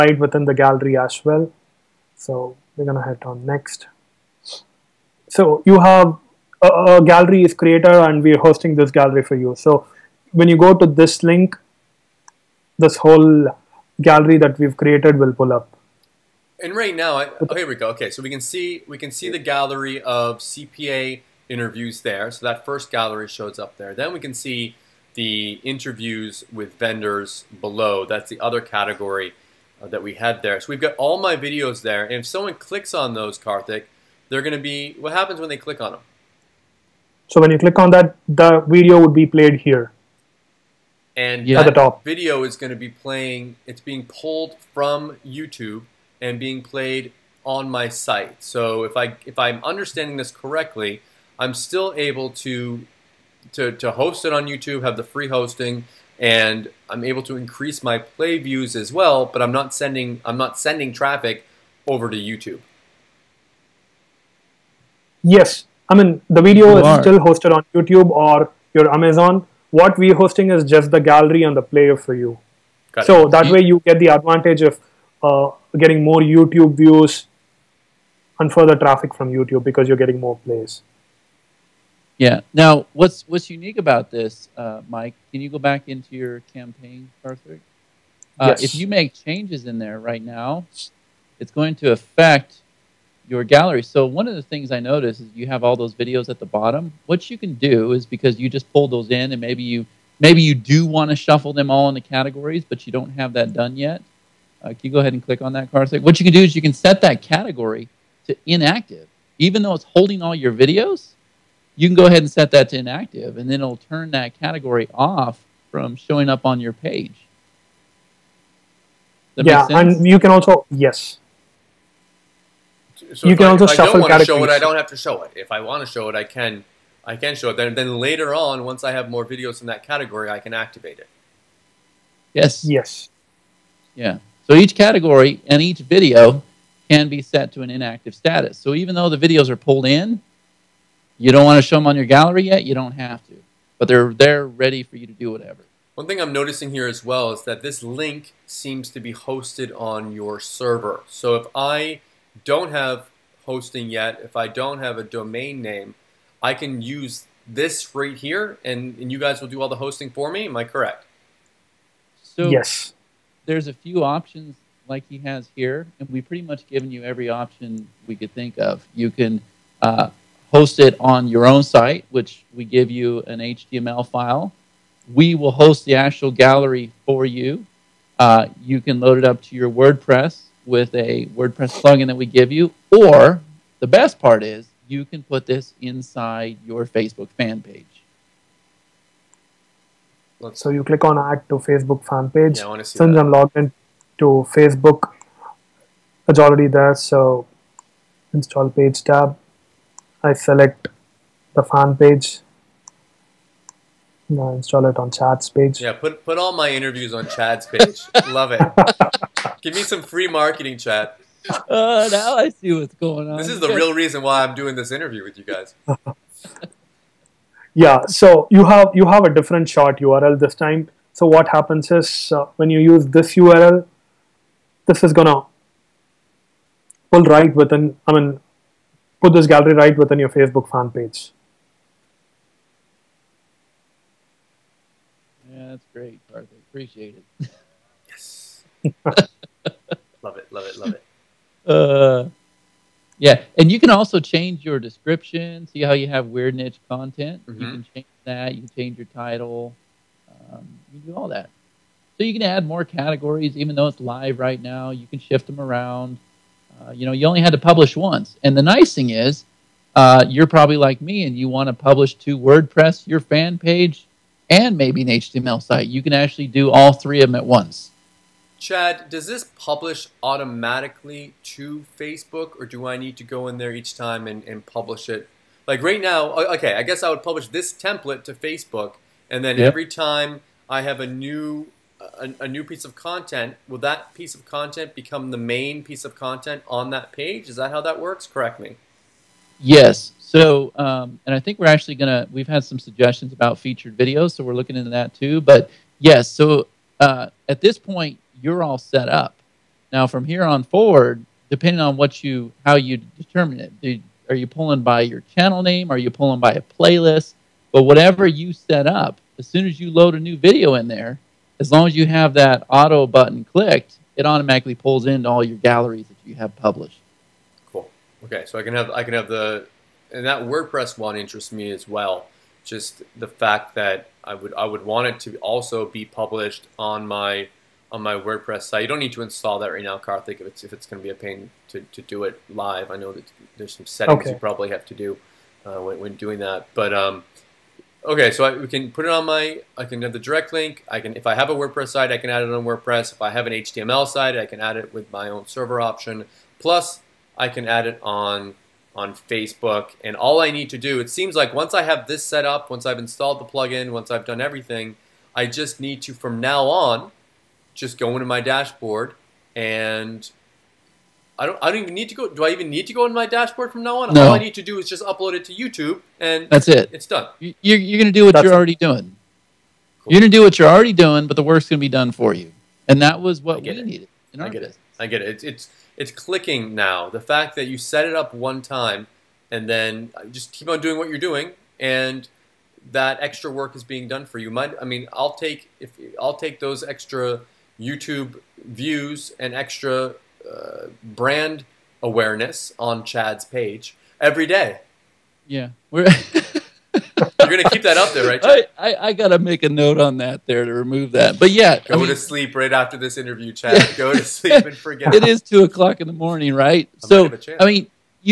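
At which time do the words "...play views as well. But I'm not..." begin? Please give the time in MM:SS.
00:57.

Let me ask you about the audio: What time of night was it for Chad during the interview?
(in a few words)
2 o'clock in the morning.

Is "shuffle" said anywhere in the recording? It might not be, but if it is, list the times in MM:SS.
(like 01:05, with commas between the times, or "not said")
01:41, 02:03.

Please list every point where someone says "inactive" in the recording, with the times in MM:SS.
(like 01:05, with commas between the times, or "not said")
01:48, 01:52, 02:17.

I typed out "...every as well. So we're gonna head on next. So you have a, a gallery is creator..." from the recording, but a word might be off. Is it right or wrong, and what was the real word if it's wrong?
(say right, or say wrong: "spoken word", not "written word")
wrong: "gallery", not "every".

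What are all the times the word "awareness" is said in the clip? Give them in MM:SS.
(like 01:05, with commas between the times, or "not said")
06:32.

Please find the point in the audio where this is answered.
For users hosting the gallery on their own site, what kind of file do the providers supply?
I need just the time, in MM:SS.
02:53.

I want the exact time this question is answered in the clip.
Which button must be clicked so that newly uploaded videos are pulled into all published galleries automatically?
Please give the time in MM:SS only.
05:12.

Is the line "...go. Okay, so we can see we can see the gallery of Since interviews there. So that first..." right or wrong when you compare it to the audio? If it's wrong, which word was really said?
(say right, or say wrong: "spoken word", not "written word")
wrong: "CPA", not "Since".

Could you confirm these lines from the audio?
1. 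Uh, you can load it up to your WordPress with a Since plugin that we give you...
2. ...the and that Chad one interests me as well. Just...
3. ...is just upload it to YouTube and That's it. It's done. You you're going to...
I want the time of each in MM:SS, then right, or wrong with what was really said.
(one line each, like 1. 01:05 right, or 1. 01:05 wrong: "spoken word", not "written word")
1. 02:58 wrong: "WordPress", not "Since"
2. 05:19 wrong: "WordPress", not "Chad"
3. 06:04 right.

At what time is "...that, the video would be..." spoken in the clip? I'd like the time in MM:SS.
00:37.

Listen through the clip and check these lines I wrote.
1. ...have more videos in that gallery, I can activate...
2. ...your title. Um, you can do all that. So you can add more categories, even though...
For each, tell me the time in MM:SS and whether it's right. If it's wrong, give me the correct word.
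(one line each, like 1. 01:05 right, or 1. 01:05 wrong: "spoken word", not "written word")
1. 02:08 wrong: "category", not "gallery"
2. 04:08 right.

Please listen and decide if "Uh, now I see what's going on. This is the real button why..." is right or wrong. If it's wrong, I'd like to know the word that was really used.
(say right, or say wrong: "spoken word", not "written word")
wrong: "reason", not "button".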